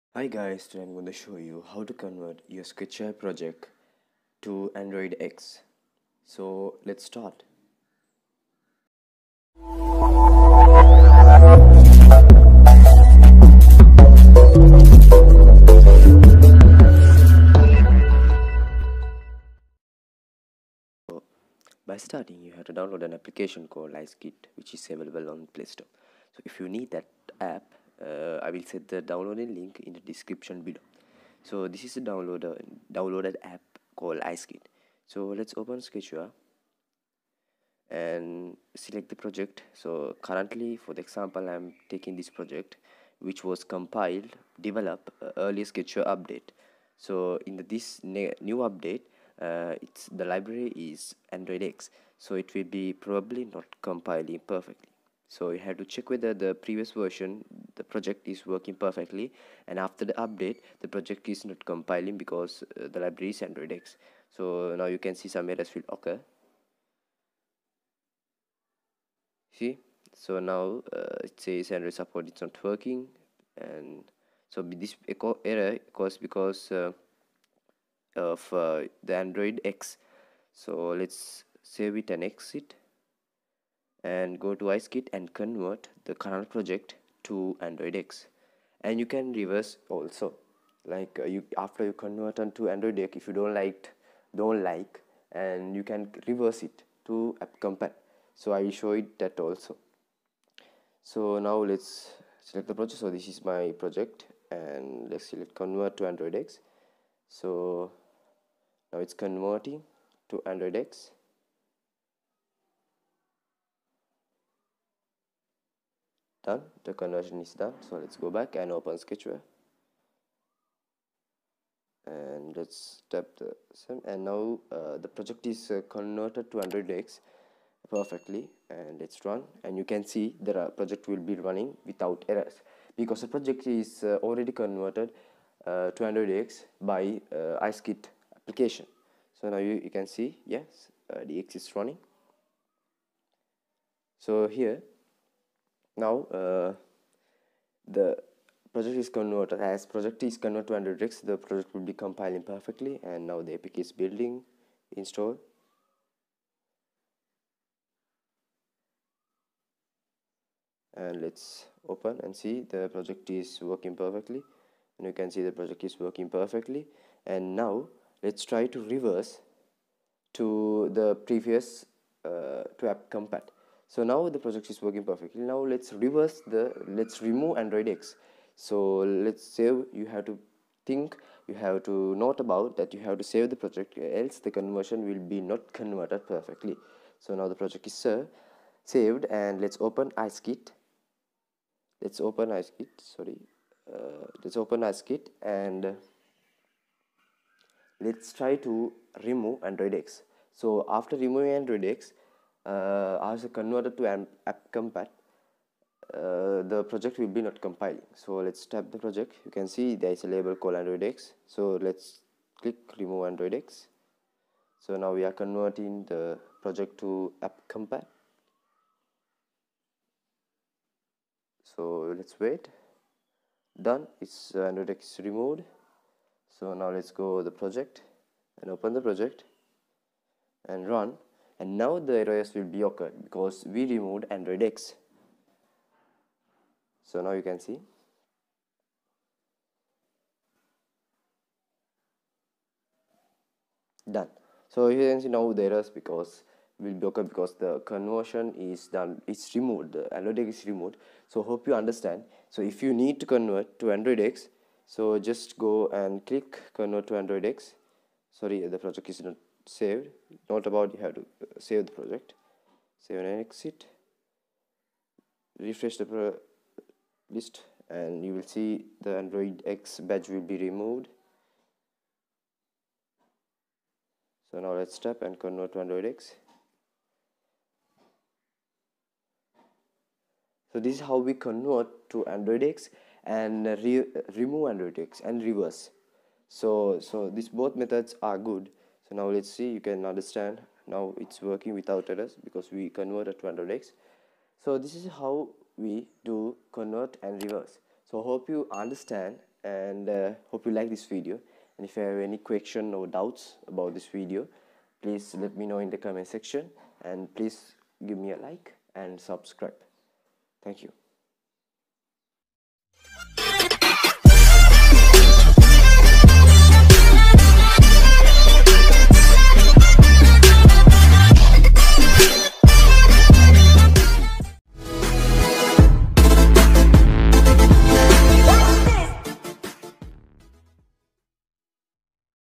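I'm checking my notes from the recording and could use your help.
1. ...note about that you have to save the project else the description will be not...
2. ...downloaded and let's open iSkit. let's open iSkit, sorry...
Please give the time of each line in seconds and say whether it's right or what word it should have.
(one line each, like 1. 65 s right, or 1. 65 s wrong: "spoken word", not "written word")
1. 182 s wrong: "conversion", not "description"
2. 188 s wrong: "saved", not "downloaded".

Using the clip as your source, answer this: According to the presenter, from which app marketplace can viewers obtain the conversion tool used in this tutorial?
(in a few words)
Play Store.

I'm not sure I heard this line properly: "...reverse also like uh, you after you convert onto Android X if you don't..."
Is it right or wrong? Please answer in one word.
right.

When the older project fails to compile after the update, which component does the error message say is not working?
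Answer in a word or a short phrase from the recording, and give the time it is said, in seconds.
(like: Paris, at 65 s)
Android support, at 71 s.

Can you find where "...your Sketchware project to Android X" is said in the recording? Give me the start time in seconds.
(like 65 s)
2 s.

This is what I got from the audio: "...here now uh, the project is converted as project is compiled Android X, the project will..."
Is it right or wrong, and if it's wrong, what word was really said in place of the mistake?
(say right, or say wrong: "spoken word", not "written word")
wrong: "converted", not "compiled".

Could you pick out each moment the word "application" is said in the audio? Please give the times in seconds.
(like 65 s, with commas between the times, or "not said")
23 s, 138 s.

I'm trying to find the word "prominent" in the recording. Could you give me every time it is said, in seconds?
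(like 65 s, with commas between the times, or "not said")
not said.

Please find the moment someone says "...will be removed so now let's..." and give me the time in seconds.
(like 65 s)
270 s.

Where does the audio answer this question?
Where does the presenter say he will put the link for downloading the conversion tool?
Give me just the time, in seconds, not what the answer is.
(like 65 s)
29 s.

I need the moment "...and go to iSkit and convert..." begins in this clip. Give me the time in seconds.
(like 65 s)
84 s.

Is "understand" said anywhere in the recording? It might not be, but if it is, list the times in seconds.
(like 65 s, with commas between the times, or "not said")
251 s, 290 s, 298 s.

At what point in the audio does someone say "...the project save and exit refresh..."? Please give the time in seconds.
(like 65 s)
261 s.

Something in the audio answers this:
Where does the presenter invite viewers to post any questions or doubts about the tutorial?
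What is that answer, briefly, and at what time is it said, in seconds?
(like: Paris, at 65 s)
The comment section, at 305 s.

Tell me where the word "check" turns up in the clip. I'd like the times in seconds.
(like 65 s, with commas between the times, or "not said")
55 s.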